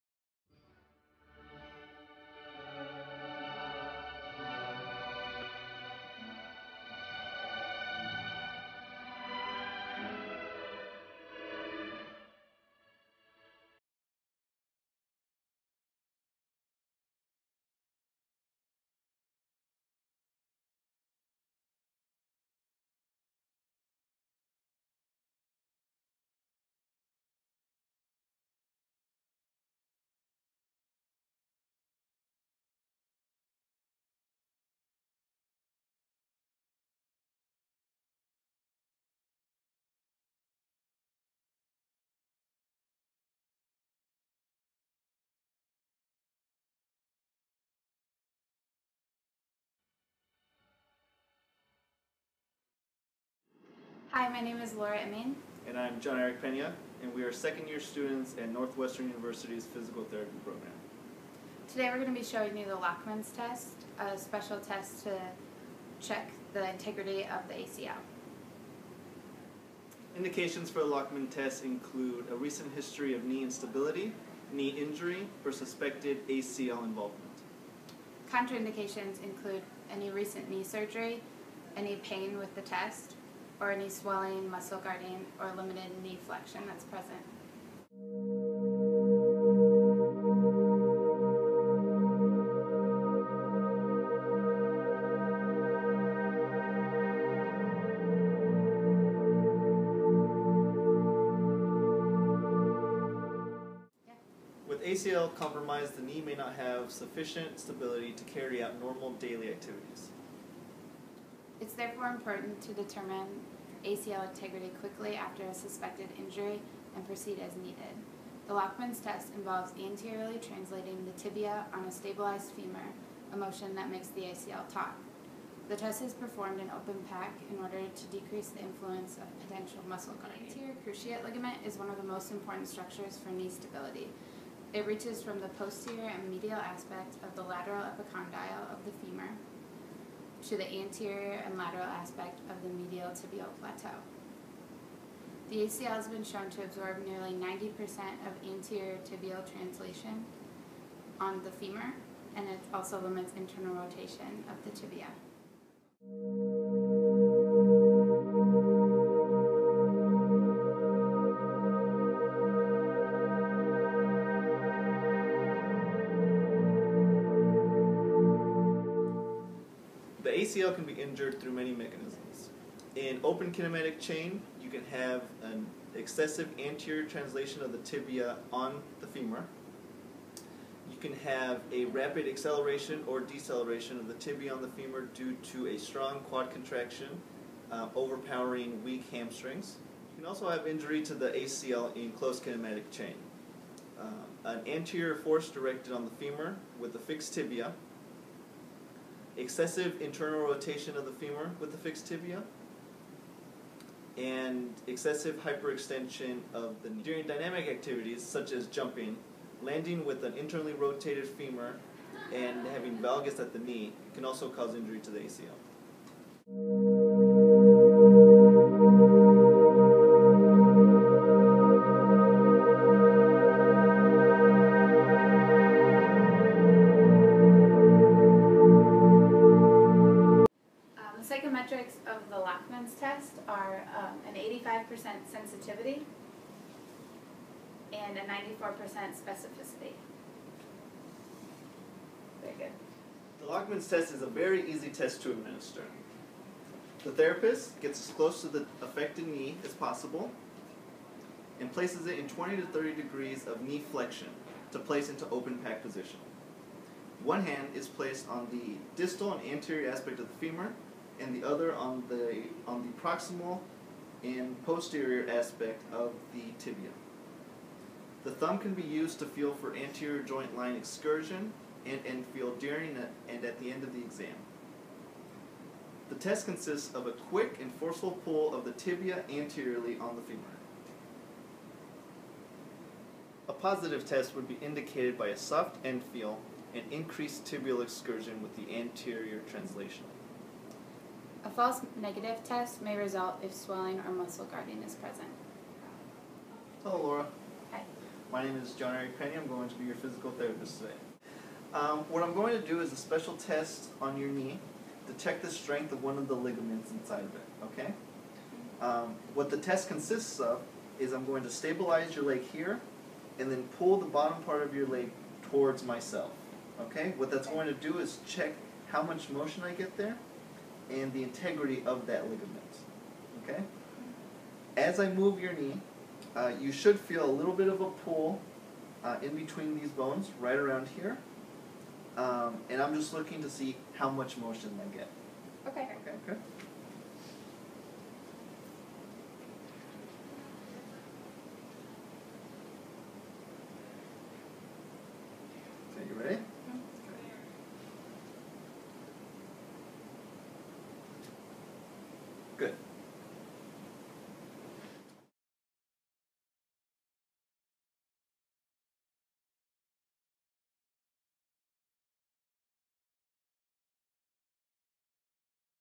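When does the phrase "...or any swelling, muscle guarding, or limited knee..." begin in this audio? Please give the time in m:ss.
1:23.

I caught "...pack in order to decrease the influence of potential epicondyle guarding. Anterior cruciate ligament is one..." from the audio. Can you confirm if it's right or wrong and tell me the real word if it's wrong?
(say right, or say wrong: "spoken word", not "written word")
wrong: "muscle", not "epicondyle".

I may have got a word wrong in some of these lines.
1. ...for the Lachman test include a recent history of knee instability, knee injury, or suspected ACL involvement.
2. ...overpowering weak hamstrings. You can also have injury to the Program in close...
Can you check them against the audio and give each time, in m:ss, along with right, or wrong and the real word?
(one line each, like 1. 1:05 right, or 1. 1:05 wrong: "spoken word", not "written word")
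1. 1:10 right
2. 3:07 wrong: "ACL", not "Program".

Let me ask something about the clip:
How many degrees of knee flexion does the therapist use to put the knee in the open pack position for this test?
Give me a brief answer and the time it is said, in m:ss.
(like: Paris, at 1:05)
20 to 30 degrees, at 4:12.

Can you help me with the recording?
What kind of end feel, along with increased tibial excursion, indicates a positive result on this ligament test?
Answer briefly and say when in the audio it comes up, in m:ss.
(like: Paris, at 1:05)
soft end feel, at 4:45.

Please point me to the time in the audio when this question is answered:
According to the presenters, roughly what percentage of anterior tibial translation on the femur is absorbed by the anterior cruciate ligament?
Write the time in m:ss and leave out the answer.
2:27.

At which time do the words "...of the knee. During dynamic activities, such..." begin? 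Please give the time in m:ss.
3:26.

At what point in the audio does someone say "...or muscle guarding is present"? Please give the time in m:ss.
4:54.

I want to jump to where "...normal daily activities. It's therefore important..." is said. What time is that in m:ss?
1:48.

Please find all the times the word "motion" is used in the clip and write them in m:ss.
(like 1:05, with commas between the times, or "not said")
2:03, 5:19, 5:34.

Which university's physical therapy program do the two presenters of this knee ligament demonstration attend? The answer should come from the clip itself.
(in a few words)
Northwestern University.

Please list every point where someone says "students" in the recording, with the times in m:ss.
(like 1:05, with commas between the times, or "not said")
0:57.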